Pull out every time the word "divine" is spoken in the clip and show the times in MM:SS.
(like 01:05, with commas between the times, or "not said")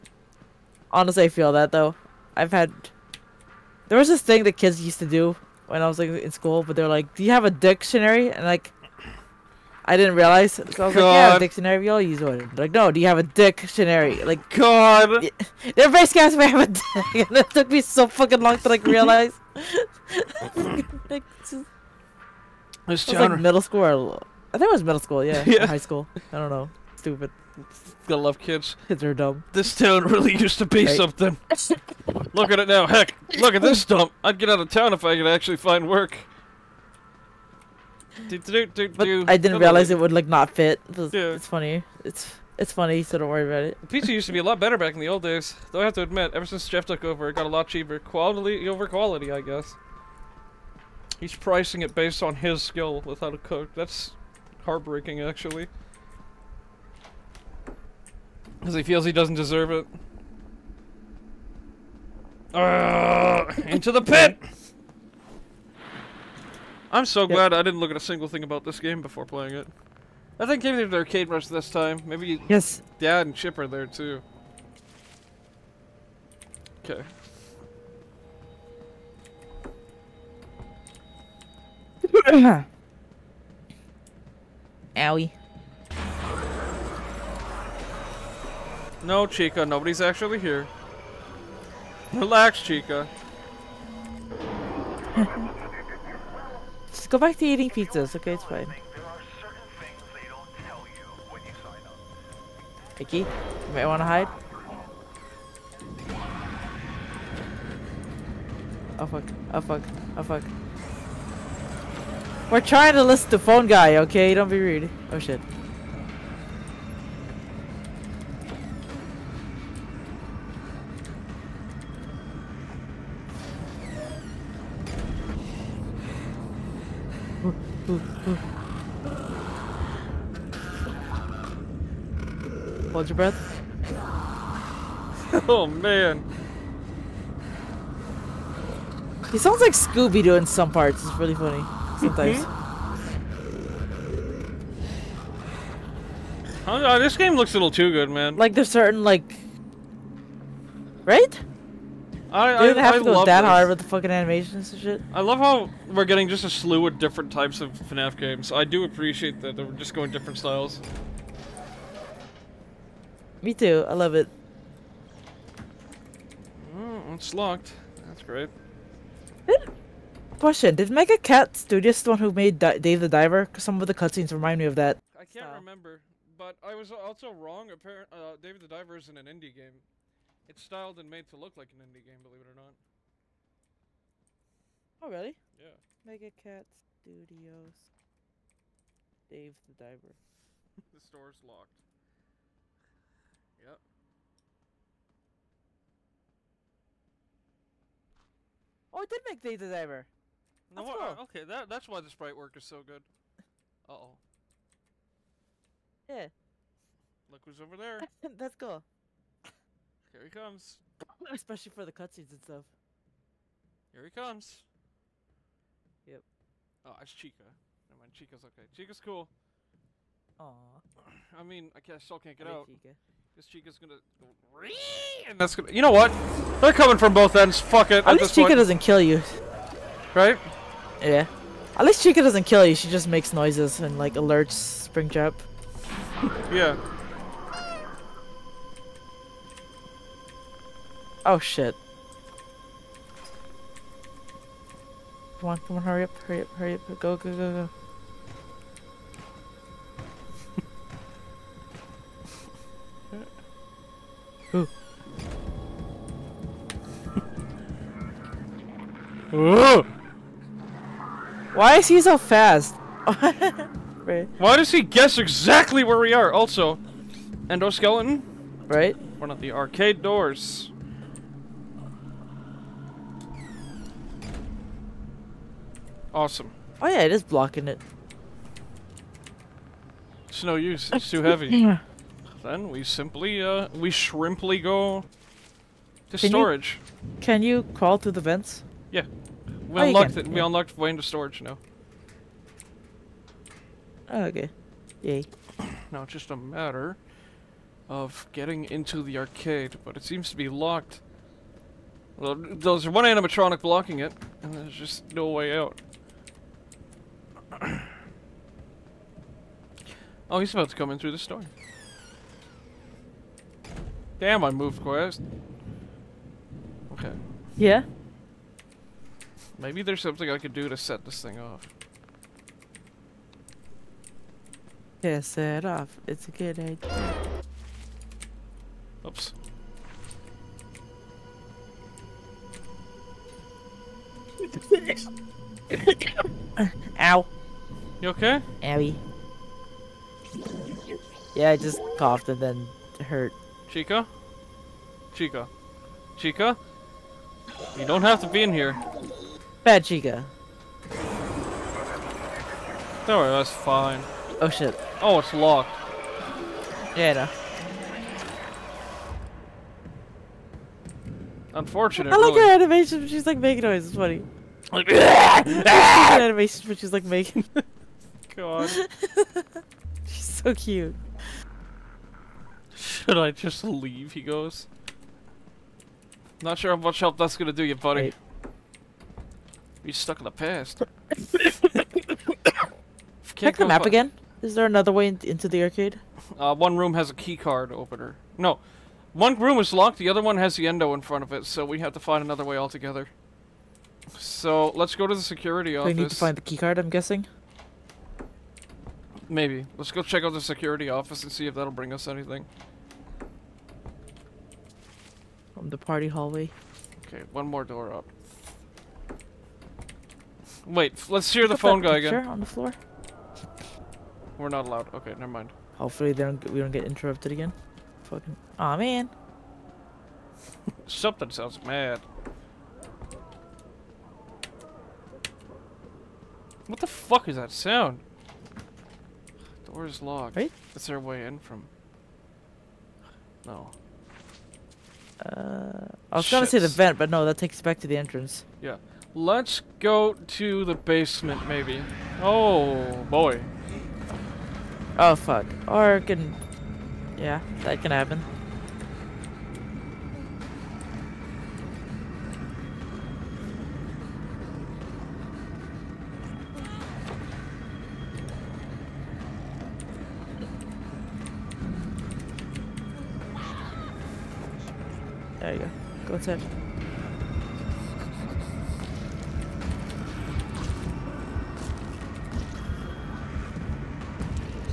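not said.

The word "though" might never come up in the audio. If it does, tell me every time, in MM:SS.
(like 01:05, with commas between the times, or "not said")
00:01, 00:45.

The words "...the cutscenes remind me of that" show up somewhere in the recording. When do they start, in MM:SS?
02:53.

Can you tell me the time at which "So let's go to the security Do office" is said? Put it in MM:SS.
06:34.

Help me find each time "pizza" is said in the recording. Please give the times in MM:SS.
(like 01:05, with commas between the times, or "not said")
00:43, 01:37.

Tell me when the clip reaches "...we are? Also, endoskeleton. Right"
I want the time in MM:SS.
04:25.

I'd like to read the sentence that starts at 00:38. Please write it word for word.
Do, do, do, but I didn't realize it would like not fit.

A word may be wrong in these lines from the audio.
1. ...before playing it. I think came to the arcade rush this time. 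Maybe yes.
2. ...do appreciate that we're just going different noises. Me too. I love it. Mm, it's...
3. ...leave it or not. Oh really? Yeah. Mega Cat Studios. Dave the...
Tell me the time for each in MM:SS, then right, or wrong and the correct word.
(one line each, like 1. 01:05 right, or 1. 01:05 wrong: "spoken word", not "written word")
1. 01:09 right
2. 02:38 wrong: "styles", not "noises"
3. 03:02 wrong: "believe", not "leave".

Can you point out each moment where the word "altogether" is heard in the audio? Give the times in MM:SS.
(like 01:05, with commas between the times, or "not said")
06:32.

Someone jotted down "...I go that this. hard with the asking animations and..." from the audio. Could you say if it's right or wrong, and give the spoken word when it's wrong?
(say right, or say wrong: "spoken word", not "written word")
wrong: "fucking", not "asking".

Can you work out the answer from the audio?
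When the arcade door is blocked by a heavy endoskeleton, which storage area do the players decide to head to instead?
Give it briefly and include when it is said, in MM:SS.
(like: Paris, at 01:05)
can storage, at 04:46.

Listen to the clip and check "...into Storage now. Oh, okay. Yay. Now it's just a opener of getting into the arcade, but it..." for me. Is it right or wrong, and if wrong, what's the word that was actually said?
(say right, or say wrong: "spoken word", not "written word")
wrong: "matter", not "opener".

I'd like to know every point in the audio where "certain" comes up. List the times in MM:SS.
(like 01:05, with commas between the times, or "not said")
02:28.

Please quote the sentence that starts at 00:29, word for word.
This town really used to be right.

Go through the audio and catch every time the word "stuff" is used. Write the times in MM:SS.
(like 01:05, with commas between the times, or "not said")
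03:32.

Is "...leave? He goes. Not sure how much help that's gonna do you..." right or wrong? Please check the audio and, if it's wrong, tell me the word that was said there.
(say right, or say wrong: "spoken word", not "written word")
right.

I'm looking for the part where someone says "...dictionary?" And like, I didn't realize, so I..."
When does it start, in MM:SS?
00:07.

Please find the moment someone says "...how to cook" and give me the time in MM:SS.
00:53.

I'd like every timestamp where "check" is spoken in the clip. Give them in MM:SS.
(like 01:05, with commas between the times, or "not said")
06:23, 06:40.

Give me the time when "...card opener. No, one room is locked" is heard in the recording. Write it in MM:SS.
06:27.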